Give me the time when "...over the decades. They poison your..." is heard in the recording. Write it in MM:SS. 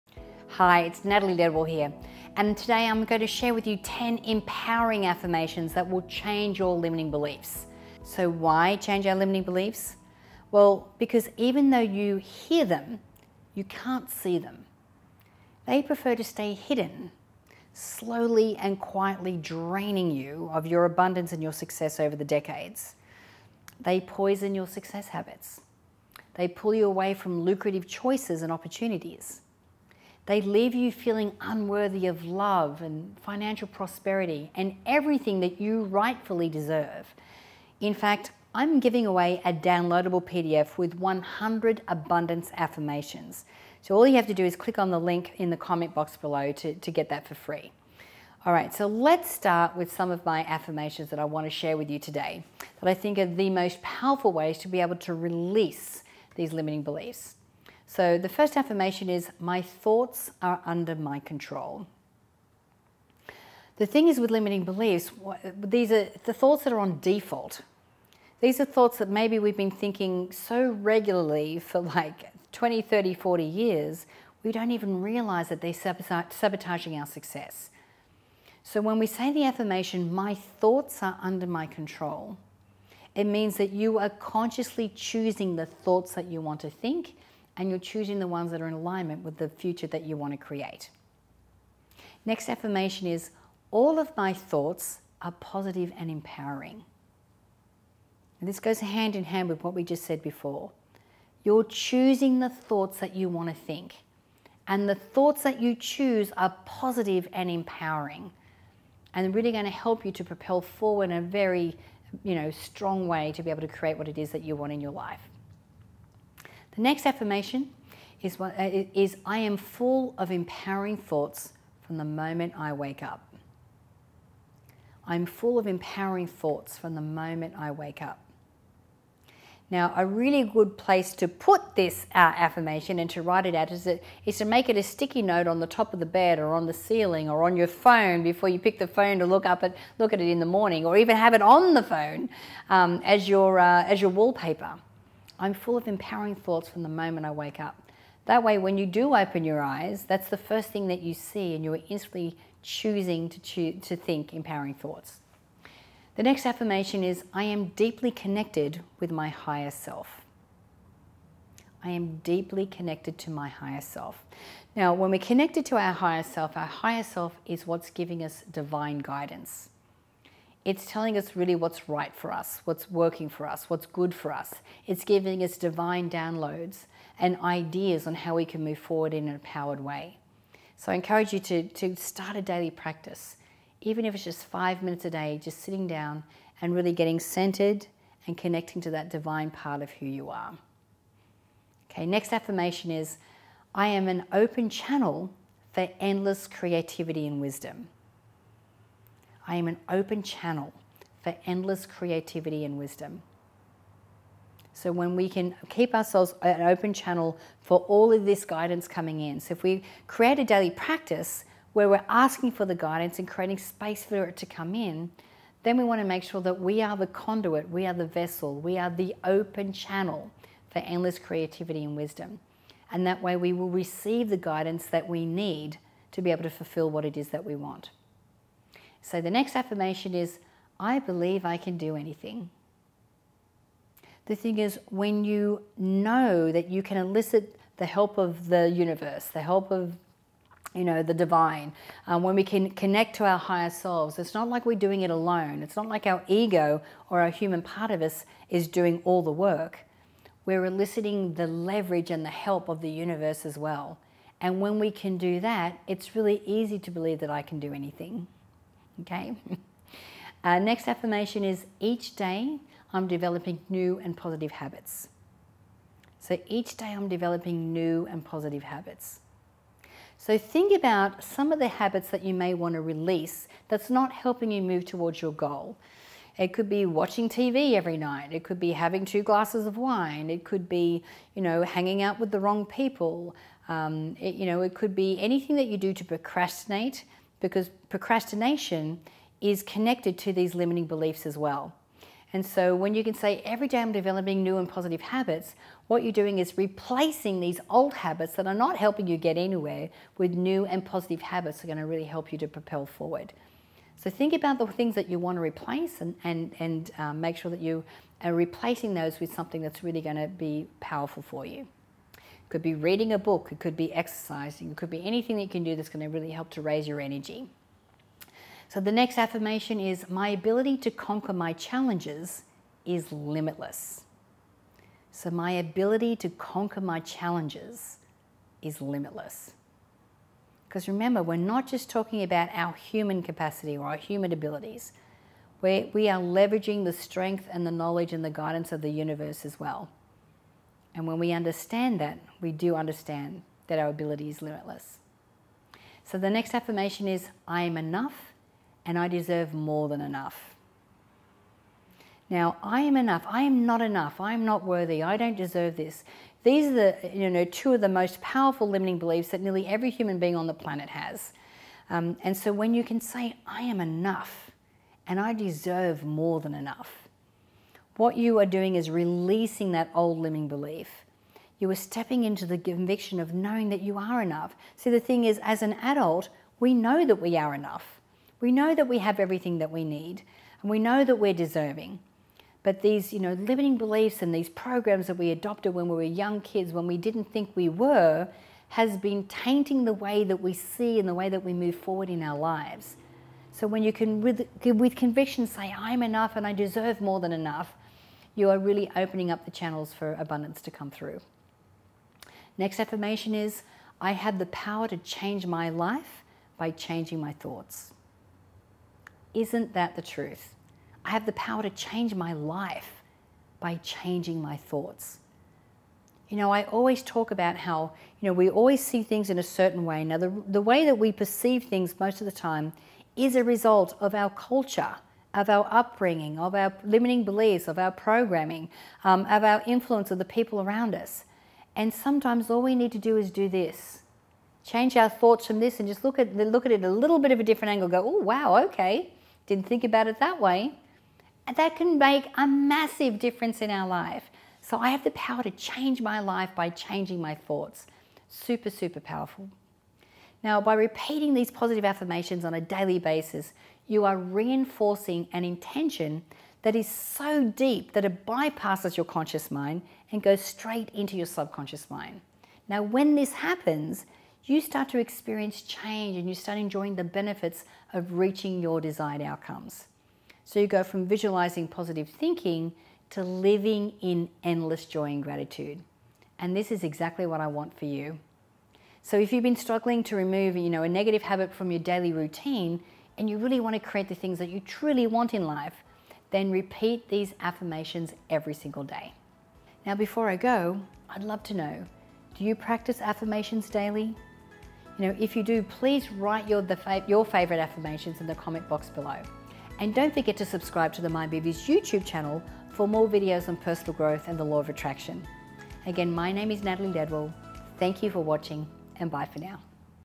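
00:21.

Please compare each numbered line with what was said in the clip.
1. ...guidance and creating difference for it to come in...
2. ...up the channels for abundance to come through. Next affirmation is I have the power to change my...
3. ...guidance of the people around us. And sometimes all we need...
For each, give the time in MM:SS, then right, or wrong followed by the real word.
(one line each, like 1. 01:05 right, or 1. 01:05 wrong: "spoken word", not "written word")
1. 03:32 wrong: "space", not "difference"
2. 06:39 right
3. 07:09 wrong: "influence", not "guidance".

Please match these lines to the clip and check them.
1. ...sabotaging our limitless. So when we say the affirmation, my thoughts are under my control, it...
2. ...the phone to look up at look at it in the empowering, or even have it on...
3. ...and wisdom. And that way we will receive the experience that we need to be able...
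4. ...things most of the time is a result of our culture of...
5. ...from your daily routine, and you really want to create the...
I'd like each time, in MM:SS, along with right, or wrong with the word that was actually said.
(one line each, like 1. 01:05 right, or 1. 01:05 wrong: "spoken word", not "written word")
1. 01:15 wrong: "success", not "limitless"
2. 02:18 wrong: "morning", not "empowering"
3. 03:41 wrong: "guidance", not "experience"
4. 07:01 right
5. 08:01 right.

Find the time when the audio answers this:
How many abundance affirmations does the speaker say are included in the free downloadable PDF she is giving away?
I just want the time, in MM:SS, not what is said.
00:40.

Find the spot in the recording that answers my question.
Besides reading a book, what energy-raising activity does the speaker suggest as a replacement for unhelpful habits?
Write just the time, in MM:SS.
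05:13.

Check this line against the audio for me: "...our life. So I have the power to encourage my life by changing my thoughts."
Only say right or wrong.
wrong.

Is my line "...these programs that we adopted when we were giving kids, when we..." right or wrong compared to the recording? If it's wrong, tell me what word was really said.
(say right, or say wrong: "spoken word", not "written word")
wrong: "young", not "giving".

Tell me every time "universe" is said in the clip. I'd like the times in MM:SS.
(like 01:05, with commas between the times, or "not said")
03:58, 04:12, 05:38.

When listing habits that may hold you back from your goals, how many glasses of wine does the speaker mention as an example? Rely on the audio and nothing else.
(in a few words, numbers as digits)
2.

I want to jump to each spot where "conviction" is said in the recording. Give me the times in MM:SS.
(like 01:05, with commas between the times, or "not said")
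06:12, 06:34.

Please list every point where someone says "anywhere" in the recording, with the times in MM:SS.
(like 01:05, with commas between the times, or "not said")
04:59.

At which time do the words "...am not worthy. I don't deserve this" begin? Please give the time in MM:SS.
05:54.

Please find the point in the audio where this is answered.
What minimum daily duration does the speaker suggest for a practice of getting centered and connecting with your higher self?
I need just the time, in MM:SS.
03:04.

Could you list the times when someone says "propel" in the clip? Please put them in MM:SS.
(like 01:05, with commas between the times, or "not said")
01:50, 05:02.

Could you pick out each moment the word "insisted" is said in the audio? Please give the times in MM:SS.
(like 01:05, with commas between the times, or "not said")
not said.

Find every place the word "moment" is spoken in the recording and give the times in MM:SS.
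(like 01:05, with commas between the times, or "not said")
02:02, 02:07, 02:26.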